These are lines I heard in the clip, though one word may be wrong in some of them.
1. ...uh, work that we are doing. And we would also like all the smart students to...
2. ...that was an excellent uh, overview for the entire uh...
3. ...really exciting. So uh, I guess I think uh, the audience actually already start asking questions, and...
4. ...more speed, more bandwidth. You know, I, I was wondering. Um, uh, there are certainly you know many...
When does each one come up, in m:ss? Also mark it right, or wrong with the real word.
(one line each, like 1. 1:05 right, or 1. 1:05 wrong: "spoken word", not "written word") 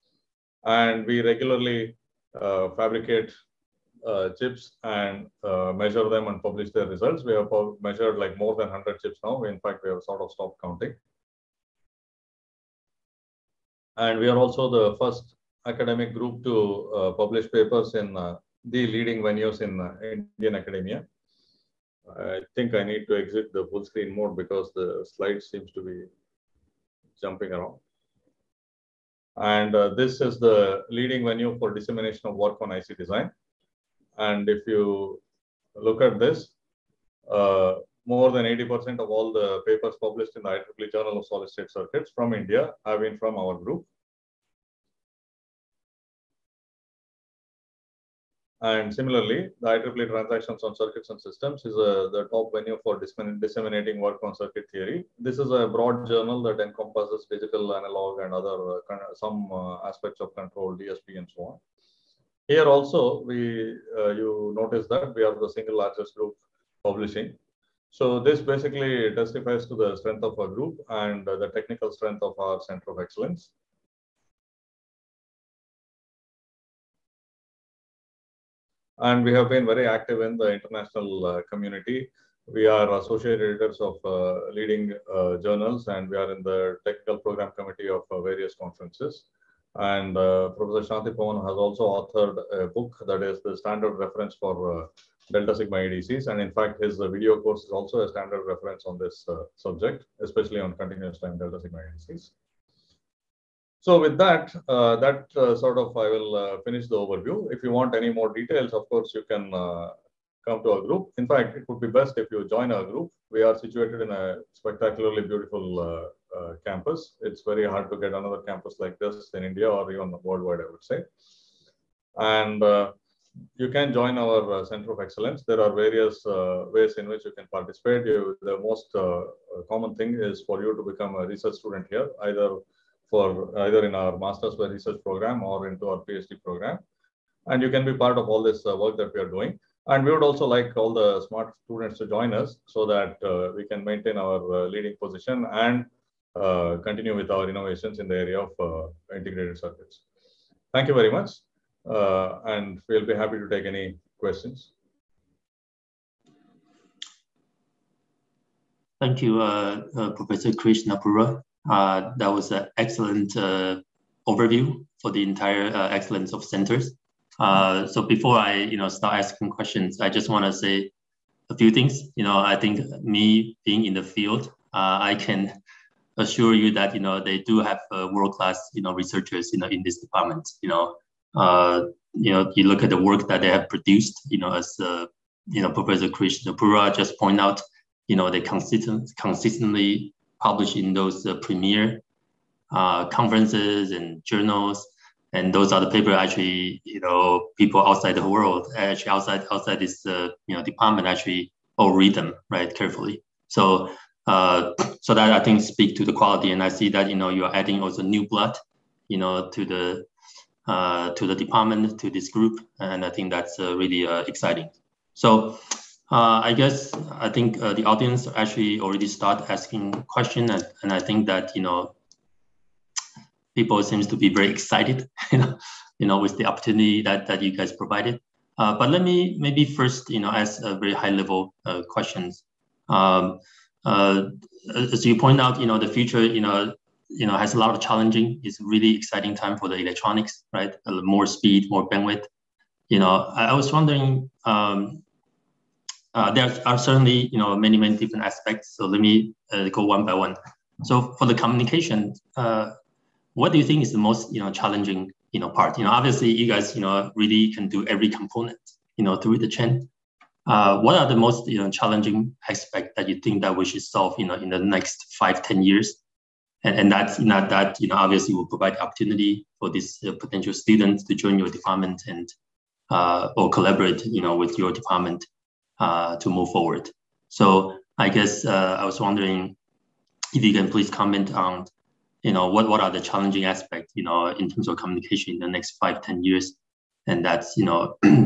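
1. 2:18 right
2. 2:42 right
3. 3:33 right
4. 4:01 right.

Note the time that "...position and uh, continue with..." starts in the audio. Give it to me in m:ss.
2:25.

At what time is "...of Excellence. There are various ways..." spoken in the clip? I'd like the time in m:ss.
2:04.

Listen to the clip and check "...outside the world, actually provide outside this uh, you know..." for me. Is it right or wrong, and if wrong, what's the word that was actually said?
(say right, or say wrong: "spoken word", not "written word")
wrong: "outside", not "provide".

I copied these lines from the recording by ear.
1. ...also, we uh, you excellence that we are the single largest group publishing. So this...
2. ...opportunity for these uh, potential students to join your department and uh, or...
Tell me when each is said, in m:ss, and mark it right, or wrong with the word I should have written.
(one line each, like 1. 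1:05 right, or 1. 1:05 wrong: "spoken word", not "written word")
1. 1:02 wrong: "notice", not "excellence"
2. 4:28 right.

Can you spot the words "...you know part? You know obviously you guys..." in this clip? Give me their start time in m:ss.
4:15.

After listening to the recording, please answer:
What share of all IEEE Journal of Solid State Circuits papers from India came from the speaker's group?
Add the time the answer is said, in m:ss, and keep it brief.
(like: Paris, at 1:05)
more than 80%, at 0:38.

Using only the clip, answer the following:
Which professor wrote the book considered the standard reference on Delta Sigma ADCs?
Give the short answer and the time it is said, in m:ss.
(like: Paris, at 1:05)
Shanti Pavan, at 1:30.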